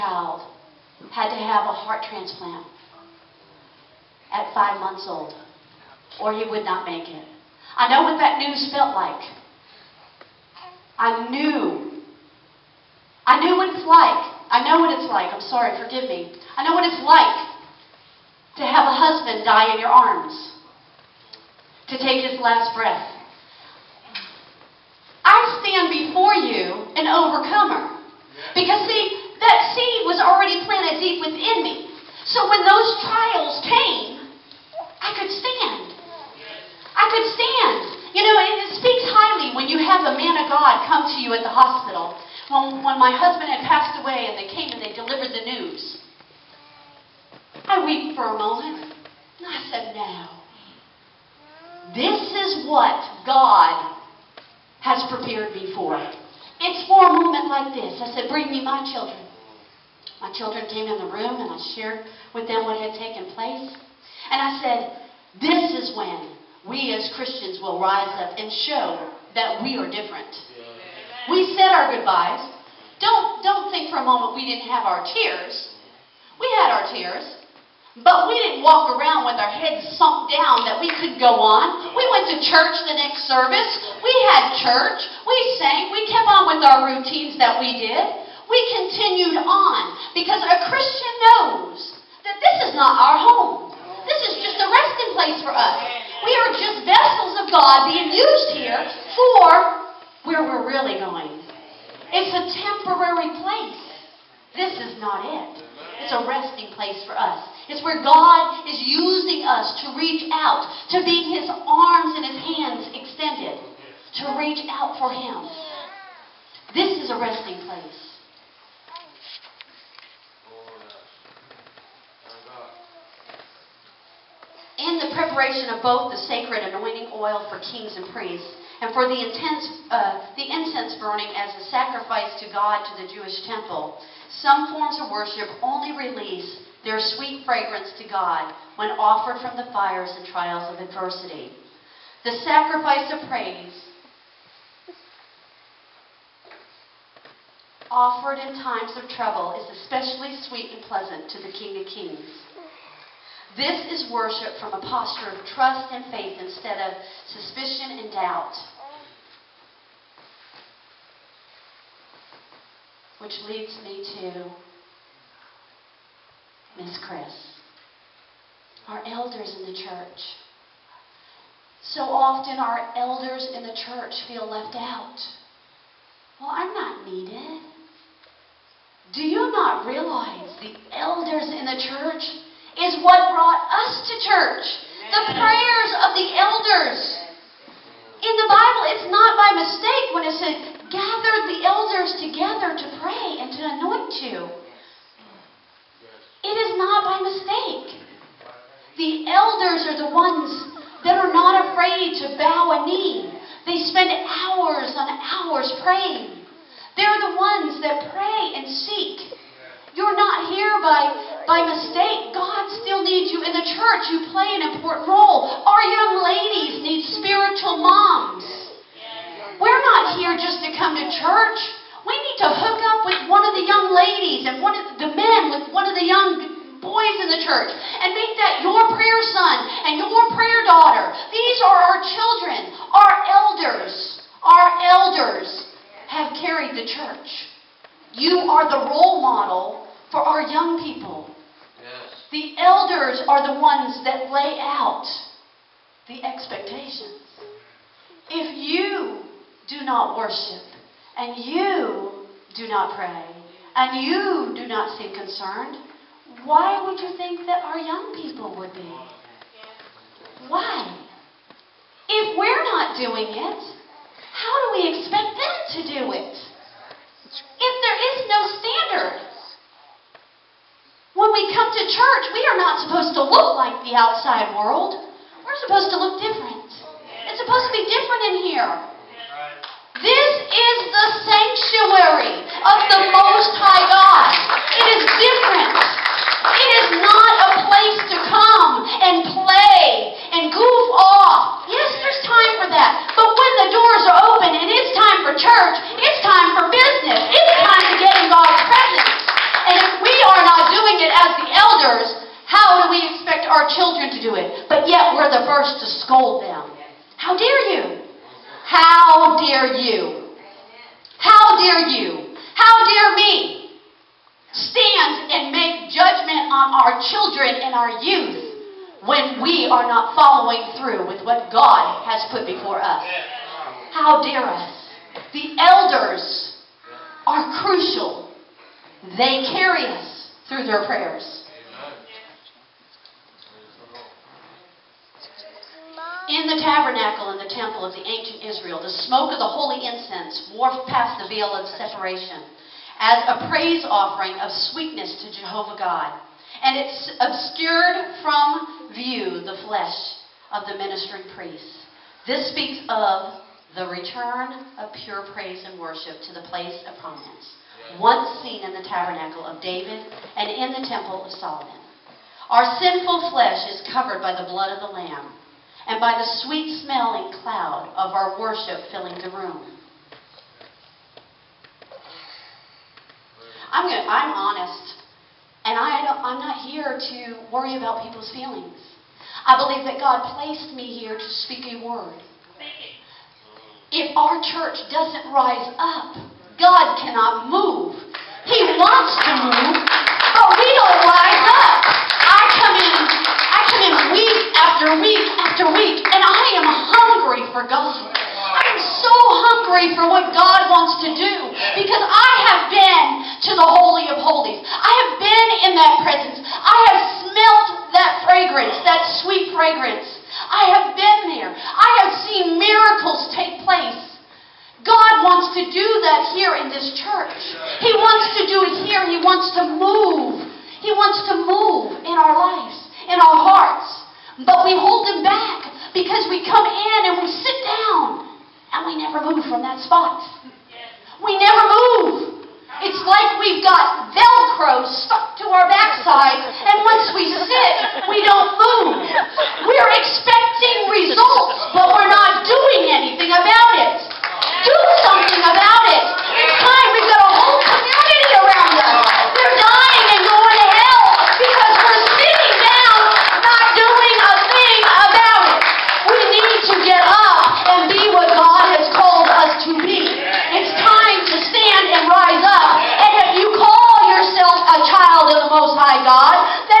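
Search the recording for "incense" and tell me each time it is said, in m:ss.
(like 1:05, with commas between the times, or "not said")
2:10, 5:39.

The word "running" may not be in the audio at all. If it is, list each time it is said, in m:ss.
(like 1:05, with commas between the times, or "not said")
not said.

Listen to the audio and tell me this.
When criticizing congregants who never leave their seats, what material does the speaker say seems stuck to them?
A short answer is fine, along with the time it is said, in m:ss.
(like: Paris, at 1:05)
Velcro, at 7:14.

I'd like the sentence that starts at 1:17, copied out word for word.
But we didn't walk around with our heads sunk down that we could go on.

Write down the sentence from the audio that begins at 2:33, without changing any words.
This is worship from a posture of trust and faith instead of suspicion and doubt.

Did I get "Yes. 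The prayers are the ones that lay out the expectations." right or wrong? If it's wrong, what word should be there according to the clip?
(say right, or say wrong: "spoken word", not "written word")
wrong: "elders", not "prayers".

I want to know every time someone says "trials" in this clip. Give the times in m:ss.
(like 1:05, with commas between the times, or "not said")
0:33, 2:20.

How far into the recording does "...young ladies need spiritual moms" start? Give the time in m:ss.
3:35.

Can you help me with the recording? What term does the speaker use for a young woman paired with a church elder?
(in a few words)
prayer daughter.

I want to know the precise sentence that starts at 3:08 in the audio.
In the Bible, it's not by mistake when it says, gather the elders together to pray and to anoint you.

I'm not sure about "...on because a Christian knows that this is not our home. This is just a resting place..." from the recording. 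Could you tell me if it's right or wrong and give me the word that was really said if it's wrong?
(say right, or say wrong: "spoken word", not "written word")
right.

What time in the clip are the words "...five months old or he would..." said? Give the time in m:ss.
0:04.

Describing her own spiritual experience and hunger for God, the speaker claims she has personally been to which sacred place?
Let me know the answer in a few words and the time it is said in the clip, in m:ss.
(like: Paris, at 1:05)
Holy of Holies, at 6:43.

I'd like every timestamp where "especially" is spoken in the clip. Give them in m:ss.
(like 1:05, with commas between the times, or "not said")
2:29.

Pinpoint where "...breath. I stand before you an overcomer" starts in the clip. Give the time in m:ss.
0:22.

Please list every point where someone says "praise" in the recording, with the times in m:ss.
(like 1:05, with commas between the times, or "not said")
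2:23, 5:43, 5:55.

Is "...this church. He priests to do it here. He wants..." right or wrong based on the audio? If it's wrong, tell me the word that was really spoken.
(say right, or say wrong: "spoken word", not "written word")
wrong: "wants", not "priests".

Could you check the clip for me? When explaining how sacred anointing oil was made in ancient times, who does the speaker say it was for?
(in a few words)
kings and priests.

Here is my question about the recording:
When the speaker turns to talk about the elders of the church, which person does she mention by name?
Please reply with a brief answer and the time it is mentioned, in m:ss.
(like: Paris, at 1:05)
Miss Chris, at 2:46.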